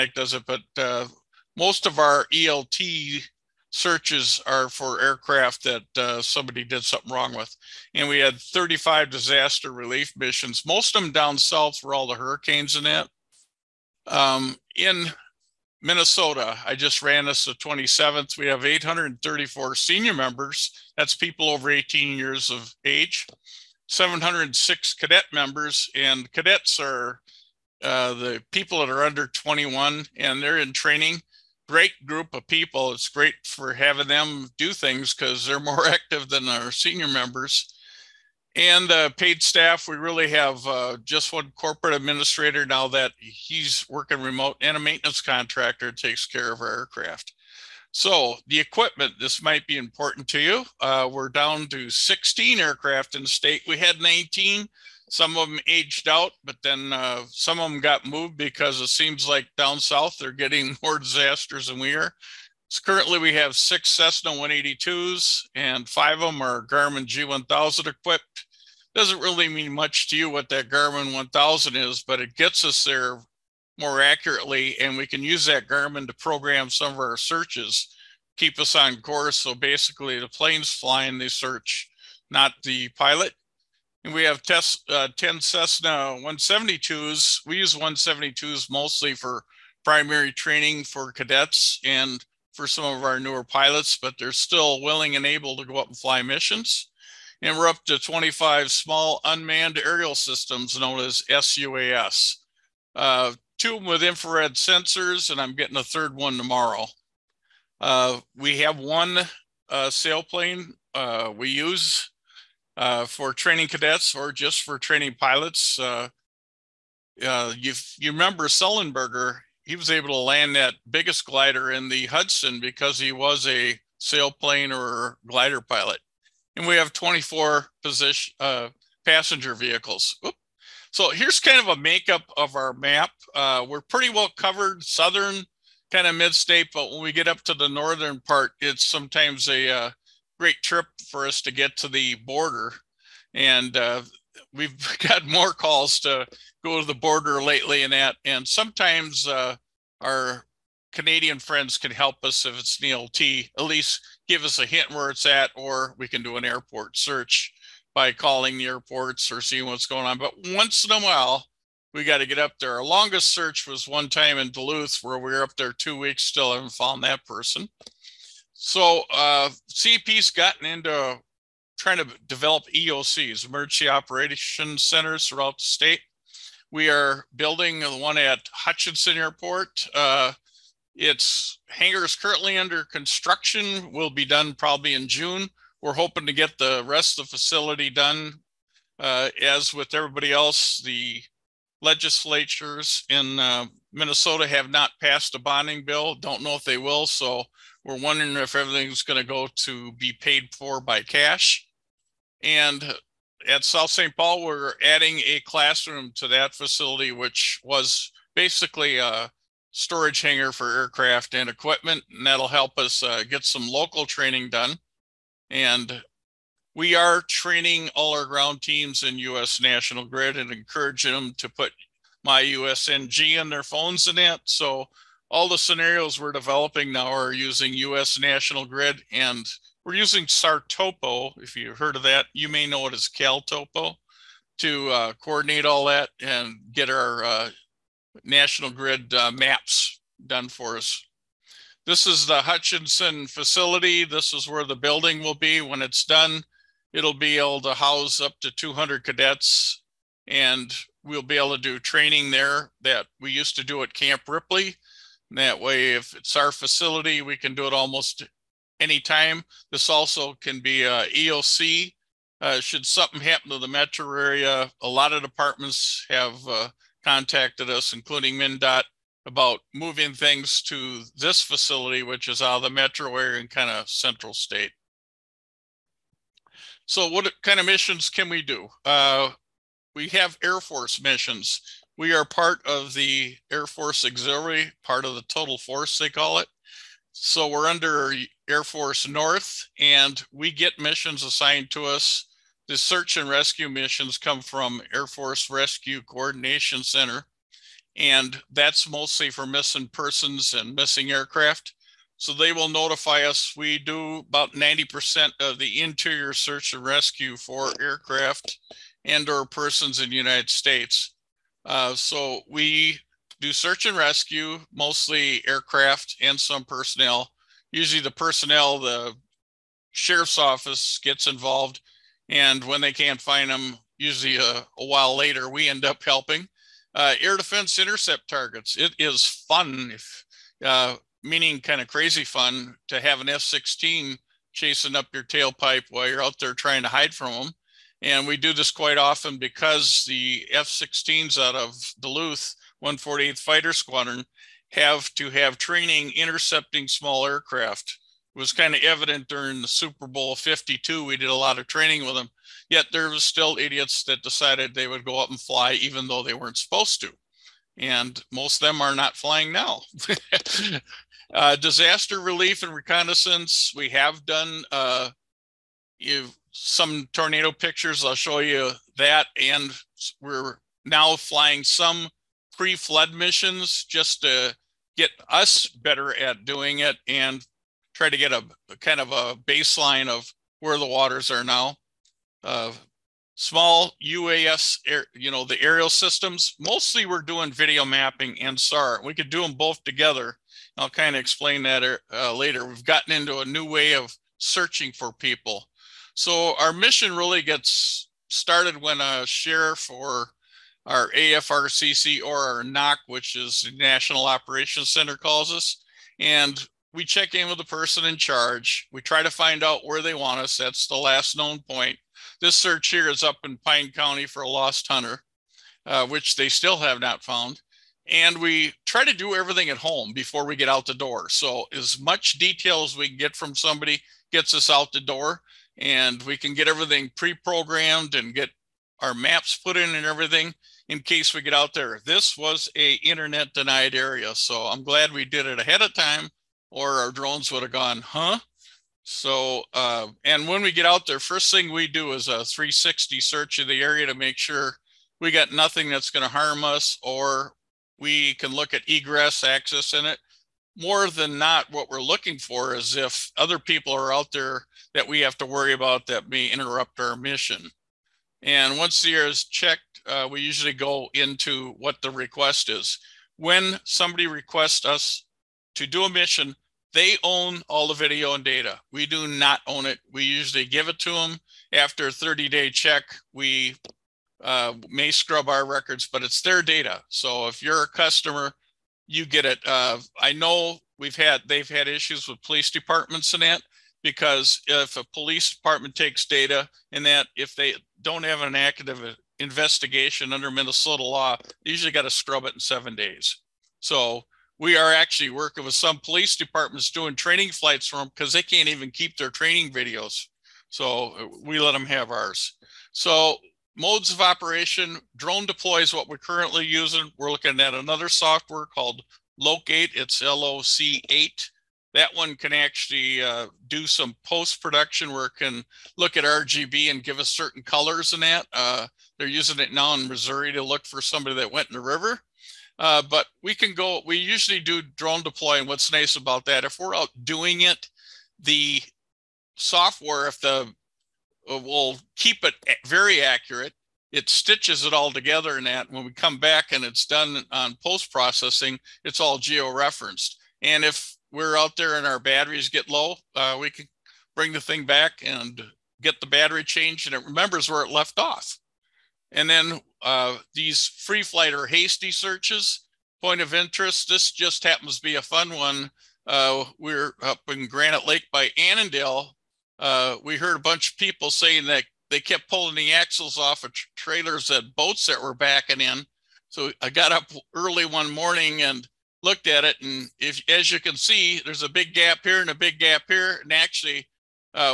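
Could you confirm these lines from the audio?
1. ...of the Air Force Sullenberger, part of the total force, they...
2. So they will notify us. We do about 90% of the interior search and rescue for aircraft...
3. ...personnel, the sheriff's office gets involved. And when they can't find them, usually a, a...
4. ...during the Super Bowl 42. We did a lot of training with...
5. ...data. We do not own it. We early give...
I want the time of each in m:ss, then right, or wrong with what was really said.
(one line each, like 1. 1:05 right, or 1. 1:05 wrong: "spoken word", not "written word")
1. 4:42 wrong: "Auxiliary", not "Sullenberger"
2. 5:02 right
3. 5:18 right
4. 5:49 wrong: "52", not "42"
5. 7:48 wrong: "usually", not "early".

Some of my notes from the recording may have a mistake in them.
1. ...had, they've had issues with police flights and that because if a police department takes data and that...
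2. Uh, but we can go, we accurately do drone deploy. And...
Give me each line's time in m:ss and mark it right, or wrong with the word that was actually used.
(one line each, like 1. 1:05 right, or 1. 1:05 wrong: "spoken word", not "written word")
1. 8:01 wrong: "departments", not "flights"
2. 8:42 wrong: "usually", not "accurately".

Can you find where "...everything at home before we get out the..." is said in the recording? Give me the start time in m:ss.
6:59.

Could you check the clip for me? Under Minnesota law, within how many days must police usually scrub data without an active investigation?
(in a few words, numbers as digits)
7 days.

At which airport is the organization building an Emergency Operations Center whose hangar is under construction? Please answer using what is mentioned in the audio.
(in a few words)
Hutchinson Airport.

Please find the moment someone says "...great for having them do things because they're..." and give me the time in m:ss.
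0:33.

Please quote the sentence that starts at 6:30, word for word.
I'll kind of explain that uh, later.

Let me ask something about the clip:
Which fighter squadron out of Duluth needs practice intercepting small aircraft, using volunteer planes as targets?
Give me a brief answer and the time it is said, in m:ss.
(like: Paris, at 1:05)
148th Fighter Squadron, at 5:42.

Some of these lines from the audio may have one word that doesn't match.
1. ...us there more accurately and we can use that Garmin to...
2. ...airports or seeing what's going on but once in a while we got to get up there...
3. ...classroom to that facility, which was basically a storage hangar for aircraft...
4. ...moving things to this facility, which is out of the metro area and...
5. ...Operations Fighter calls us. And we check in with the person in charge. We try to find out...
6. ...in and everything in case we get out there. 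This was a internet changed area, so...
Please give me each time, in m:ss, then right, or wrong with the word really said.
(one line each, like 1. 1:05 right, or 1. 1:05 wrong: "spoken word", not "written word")
1. 1:12 right
2. 2:38 right
3. 3:25 right
4. 4:29 right
5. 6:44 wrong: "Center", not "Fighter"
6. 7:09 wrong: "denied", not "changed".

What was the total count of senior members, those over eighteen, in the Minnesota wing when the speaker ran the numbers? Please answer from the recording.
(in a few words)
834.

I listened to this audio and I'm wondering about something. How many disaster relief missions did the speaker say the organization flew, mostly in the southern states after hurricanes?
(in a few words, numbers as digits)
35.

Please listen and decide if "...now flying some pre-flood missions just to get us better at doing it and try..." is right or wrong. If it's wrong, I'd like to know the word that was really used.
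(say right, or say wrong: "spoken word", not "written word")
right.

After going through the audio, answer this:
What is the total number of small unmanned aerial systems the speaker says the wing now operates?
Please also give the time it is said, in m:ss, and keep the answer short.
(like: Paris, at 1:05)
25, at 1:37.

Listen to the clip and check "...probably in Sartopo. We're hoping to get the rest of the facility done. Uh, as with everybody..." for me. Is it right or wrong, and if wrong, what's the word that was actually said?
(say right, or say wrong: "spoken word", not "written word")
wrong: "June", not "Sartopo".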